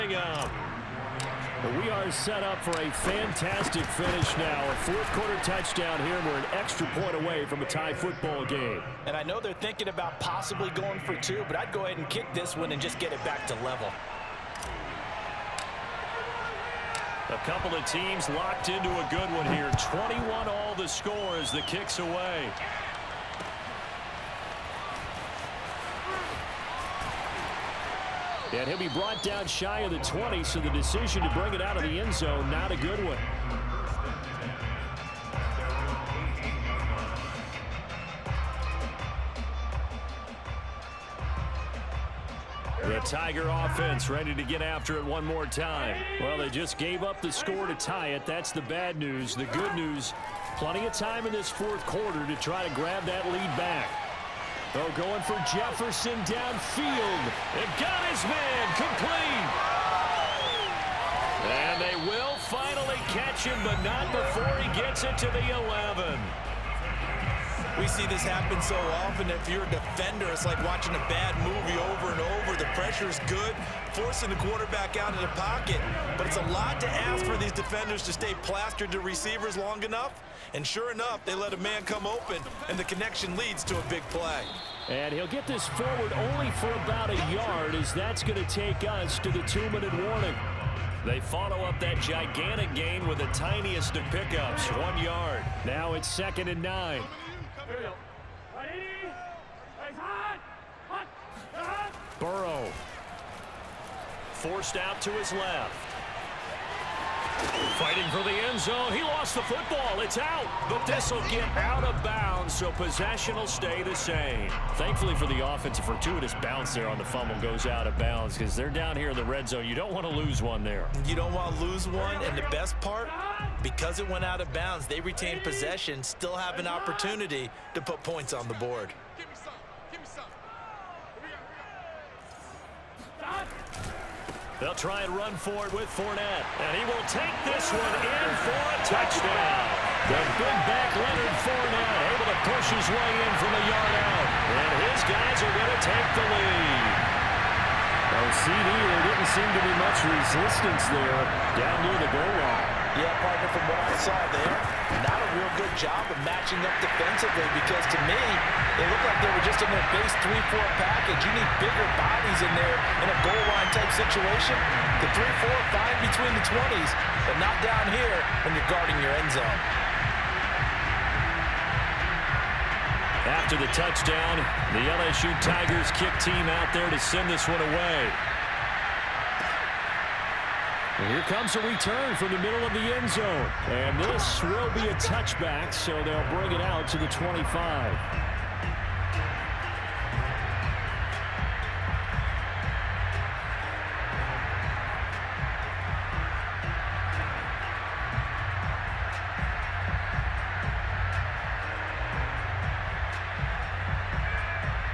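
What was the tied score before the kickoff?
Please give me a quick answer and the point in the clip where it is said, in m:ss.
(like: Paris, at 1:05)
21, at 0:19.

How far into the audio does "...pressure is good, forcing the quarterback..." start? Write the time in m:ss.
1:12.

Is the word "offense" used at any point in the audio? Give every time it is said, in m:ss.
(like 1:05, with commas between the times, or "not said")
0:43, 1:55.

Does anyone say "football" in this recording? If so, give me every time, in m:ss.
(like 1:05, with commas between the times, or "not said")
0:07, 1:49.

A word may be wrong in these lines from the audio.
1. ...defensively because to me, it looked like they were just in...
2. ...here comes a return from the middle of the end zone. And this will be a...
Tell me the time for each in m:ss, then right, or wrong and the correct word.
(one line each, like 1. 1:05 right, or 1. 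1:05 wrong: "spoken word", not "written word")
1. 2:36 right
2. 3:01 right.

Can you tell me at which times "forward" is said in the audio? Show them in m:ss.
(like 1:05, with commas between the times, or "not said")
1:25.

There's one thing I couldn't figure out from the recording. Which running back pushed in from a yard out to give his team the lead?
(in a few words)
Leonard Fournette.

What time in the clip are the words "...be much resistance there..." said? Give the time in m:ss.
2:29.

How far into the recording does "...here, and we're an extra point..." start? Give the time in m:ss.
0:06.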